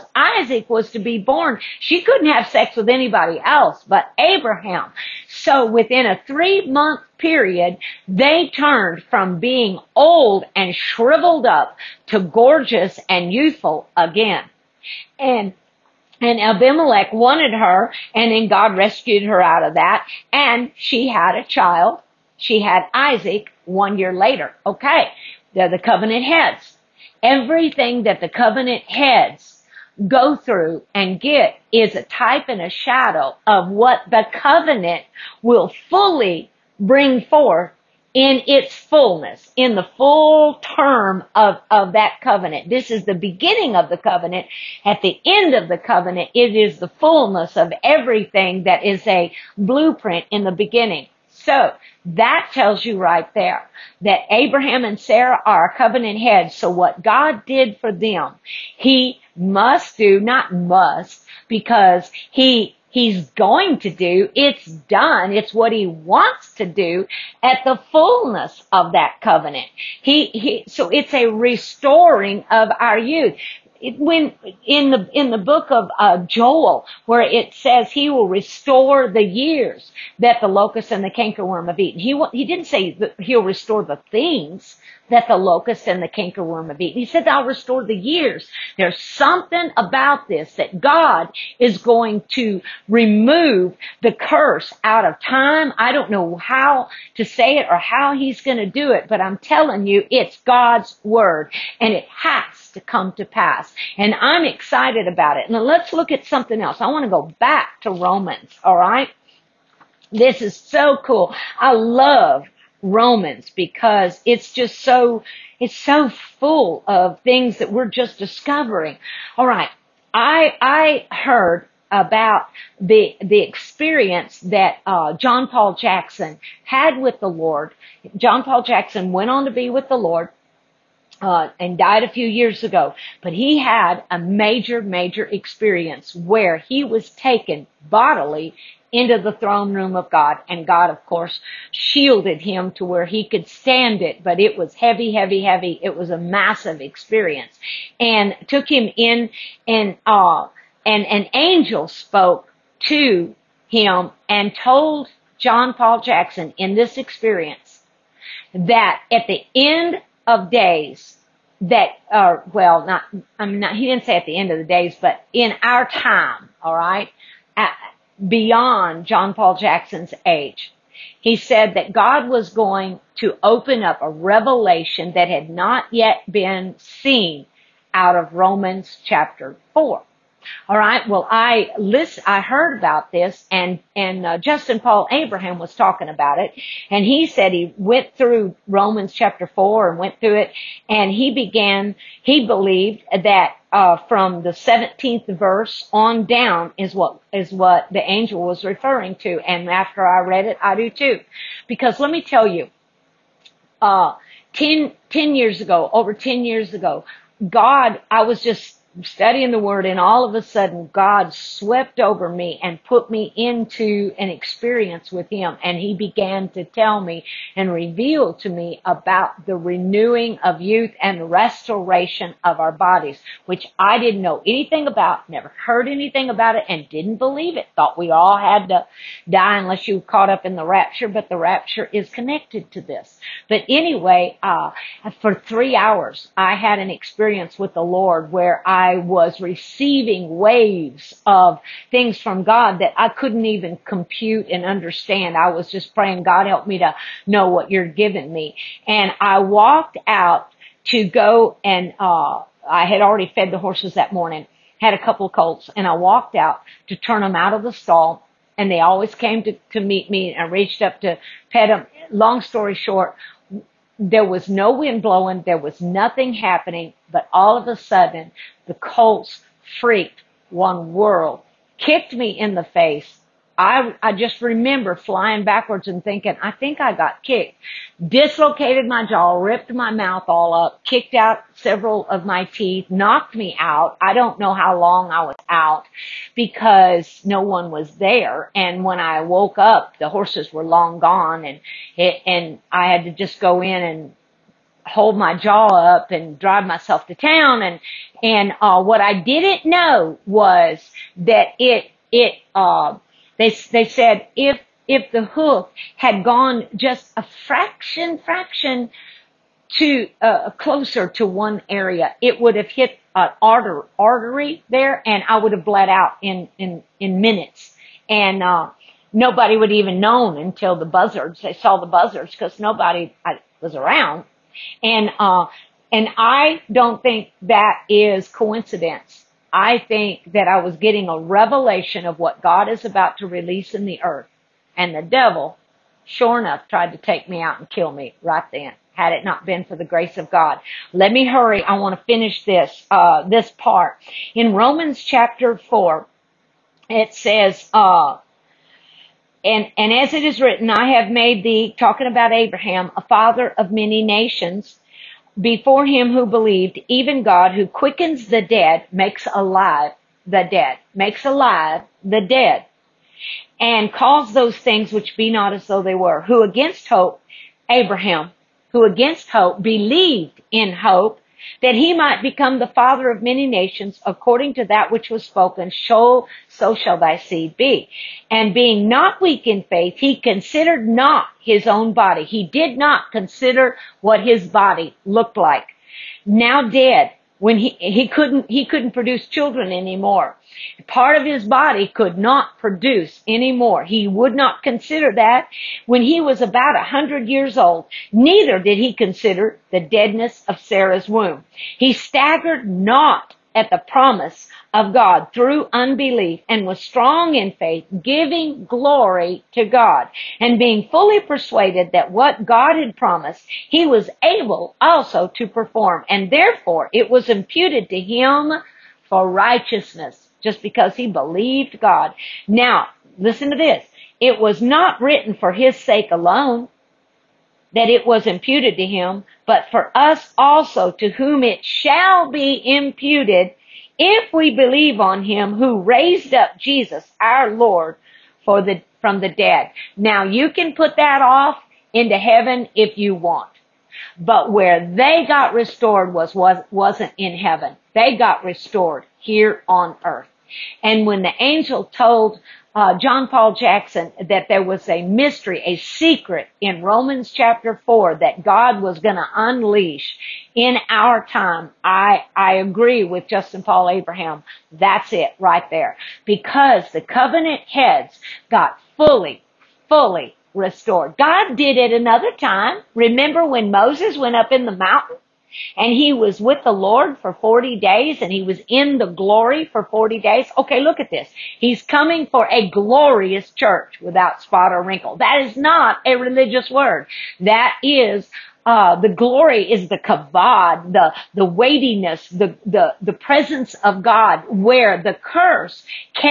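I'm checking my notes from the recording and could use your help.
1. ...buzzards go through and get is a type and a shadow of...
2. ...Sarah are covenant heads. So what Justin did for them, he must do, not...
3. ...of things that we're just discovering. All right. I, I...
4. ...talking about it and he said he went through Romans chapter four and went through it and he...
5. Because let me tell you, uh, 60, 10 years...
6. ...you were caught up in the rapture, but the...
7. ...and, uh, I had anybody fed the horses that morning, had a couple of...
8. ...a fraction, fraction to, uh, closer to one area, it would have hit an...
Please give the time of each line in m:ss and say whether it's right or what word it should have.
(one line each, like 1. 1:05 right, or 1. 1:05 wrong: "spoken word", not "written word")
1. 0:28 wrong: "heads", not "buzzards"
2. 0:54 wrong: "God", not "Justin"
3. 1:56 right
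4. 3:05 right
5. 3:21 wrong: "10", not "60"
6. 3:49 right
7. 4:11 wrong: "already", not "anybody"
8. 5:07 right.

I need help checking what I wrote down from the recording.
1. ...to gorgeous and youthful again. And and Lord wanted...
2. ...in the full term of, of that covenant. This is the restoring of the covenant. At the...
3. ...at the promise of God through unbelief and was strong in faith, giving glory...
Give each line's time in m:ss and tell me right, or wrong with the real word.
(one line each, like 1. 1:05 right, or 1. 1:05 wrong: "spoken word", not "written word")
1. 0:12 wrong: "Abimelech", not "Lord"
2. 0:39 wrong: "beginning", not "restoring"
3. 6:43 right.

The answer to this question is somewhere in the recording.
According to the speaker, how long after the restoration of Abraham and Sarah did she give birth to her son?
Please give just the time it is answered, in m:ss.
0:23.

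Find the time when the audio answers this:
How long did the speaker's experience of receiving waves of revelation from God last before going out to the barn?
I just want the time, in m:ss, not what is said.
3:55.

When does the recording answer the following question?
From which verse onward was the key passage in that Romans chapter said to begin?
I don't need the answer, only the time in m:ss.
3:14.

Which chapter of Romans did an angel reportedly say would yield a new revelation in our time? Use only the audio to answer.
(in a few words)
Chapter 4.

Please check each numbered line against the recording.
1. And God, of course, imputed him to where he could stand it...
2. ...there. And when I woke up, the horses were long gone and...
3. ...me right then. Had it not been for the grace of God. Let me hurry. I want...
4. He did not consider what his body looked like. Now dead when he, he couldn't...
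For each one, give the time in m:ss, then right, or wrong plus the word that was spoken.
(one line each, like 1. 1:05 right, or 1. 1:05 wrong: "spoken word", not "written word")
1. 2:20 wrong: "shielded", not "imputed"
2. 4:47 right
3. 5:37 right
4. 6:22 right.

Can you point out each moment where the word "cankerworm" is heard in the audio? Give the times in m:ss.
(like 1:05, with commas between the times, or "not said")
1:21, 1:26.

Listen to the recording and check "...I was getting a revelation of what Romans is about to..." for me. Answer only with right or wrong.
wrong.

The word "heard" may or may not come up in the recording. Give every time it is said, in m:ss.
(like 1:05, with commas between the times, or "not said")
2:01, 3:02, 3:45.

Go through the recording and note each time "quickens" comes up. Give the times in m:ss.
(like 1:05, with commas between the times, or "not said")
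5:57.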